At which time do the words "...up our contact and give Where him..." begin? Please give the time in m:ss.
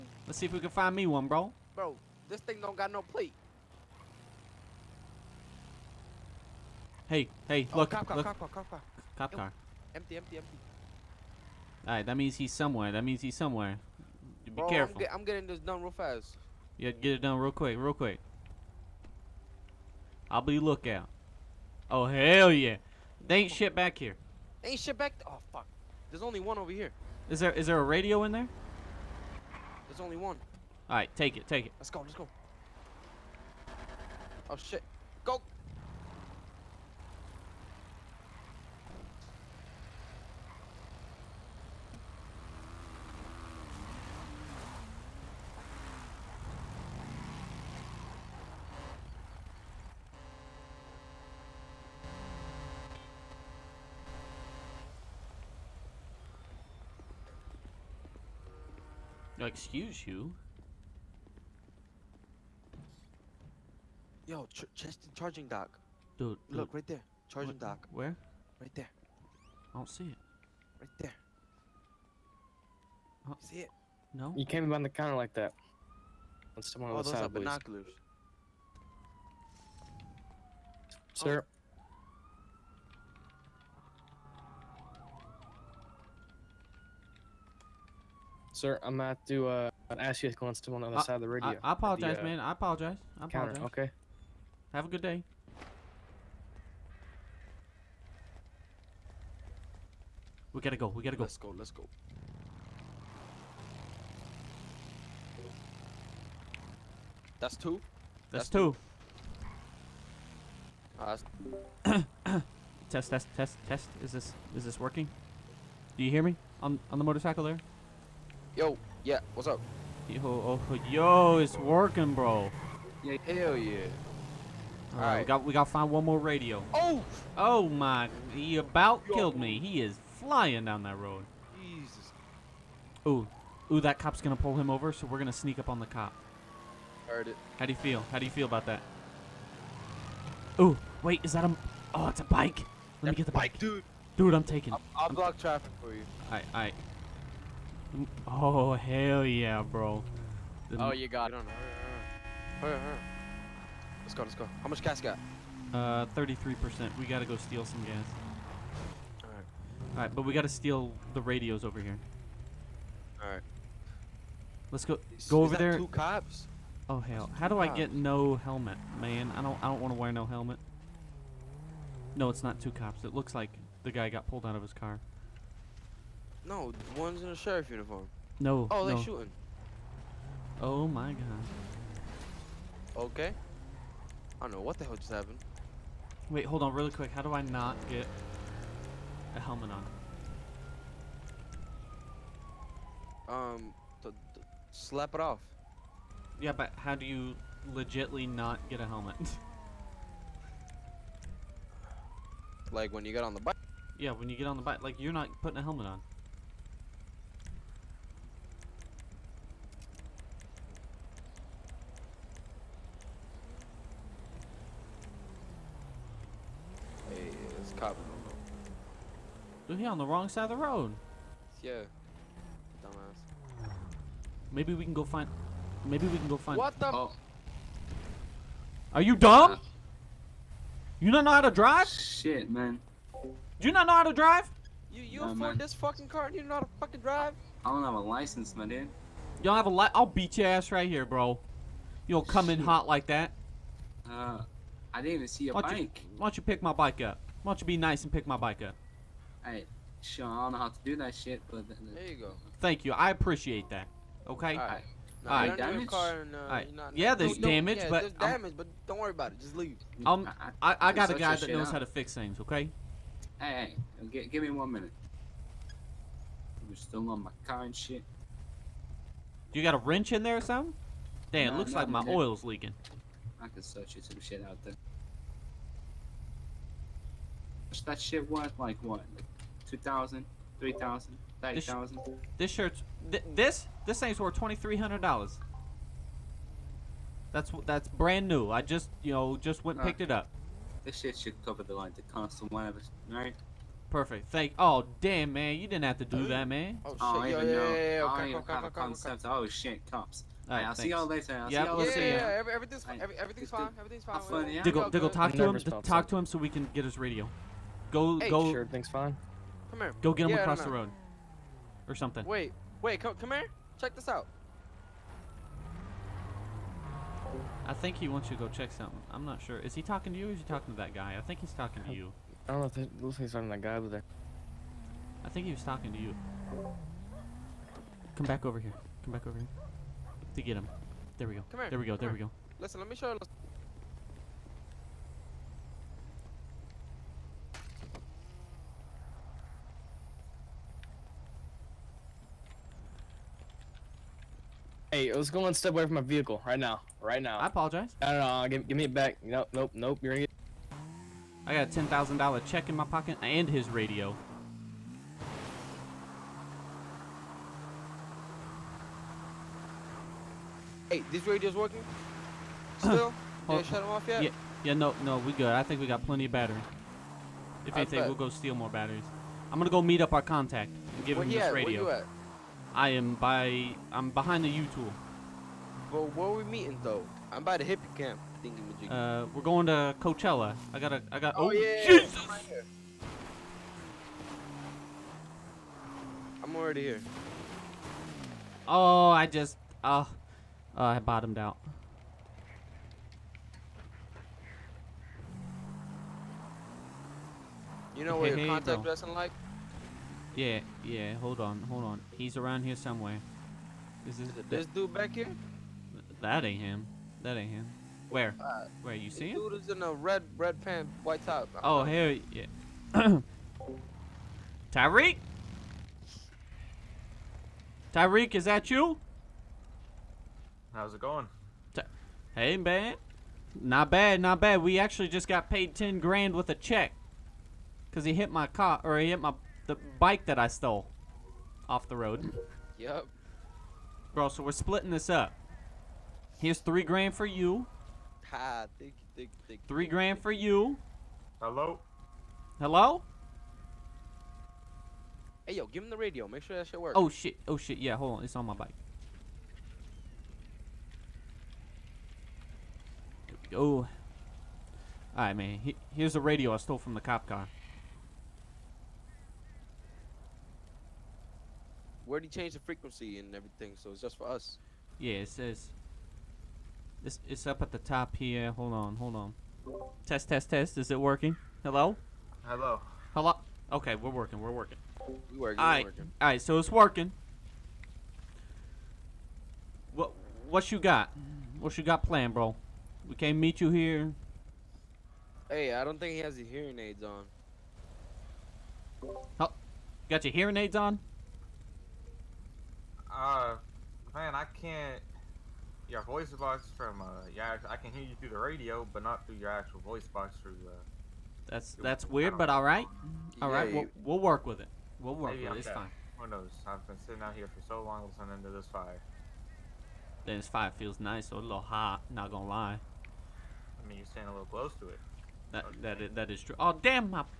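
6:10.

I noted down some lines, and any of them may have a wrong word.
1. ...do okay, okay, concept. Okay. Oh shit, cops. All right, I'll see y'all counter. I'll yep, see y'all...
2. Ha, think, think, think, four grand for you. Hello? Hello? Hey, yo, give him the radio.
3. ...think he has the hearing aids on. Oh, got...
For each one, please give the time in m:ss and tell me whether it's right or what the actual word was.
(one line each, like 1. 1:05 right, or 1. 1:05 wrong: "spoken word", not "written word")
1. 4:58 wrong: "later", not "counter"
2. 7:18 wrong: "three", not "four"
3. 8:05 right.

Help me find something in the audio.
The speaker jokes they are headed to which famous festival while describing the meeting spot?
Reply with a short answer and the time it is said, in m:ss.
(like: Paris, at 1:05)
Coachella, at 6:19.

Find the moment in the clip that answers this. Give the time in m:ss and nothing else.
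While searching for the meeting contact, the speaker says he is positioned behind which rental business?
6:14.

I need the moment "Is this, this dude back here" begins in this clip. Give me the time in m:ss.
6:44.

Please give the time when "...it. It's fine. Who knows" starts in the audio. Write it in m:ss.
8:25.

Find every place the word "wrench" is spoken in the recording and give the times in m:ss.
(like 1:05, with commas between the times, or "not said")
4:29.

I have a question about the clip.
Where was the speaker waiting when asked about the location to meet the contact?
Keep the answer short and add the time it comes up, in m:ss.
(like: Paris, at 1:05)
the hippie camp, at 6:17.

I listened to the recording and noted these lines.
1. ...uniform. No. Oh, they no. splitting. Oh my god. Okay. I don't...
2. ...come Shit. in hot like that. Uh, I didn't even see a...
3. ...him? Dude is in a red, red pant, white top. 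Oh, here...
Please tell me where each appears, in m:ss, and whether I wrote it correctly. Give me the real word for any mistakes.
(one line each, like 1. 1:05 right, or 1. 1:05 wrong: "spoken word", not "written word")
1. 2:57 wrong: "shooting", not "splitting"
2. 4:02 right
3. 6:49 right.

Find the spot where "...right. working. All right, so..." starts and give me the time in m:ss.
7:55.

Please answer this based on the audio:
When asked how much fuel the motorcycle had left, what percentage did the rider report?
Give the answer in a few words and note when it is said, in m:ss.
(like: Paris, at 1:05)
33%, at 2:36.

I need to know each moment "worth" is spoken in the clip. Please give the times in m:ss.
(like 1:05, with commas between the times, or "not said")
4:38, 4:44.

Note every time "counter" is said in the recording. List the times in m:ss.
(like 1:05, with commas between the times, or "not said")
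1:14, 1:33.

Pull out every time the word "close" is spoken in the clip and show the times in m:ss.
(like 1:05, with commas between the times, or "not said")
8:34.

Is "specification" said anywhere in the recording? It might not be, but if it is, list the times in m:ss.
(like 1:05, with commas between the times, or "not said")
not said.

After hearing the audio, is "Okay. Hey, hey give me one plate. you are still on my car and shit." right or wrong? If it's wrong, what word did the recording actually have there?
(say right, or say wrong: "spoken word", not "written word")
wrong: "minute", not "plate".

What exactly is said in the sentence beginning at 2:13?
Ooh, ooh, that cop's gonna pull him over, so we're gonna sneak up on the cop.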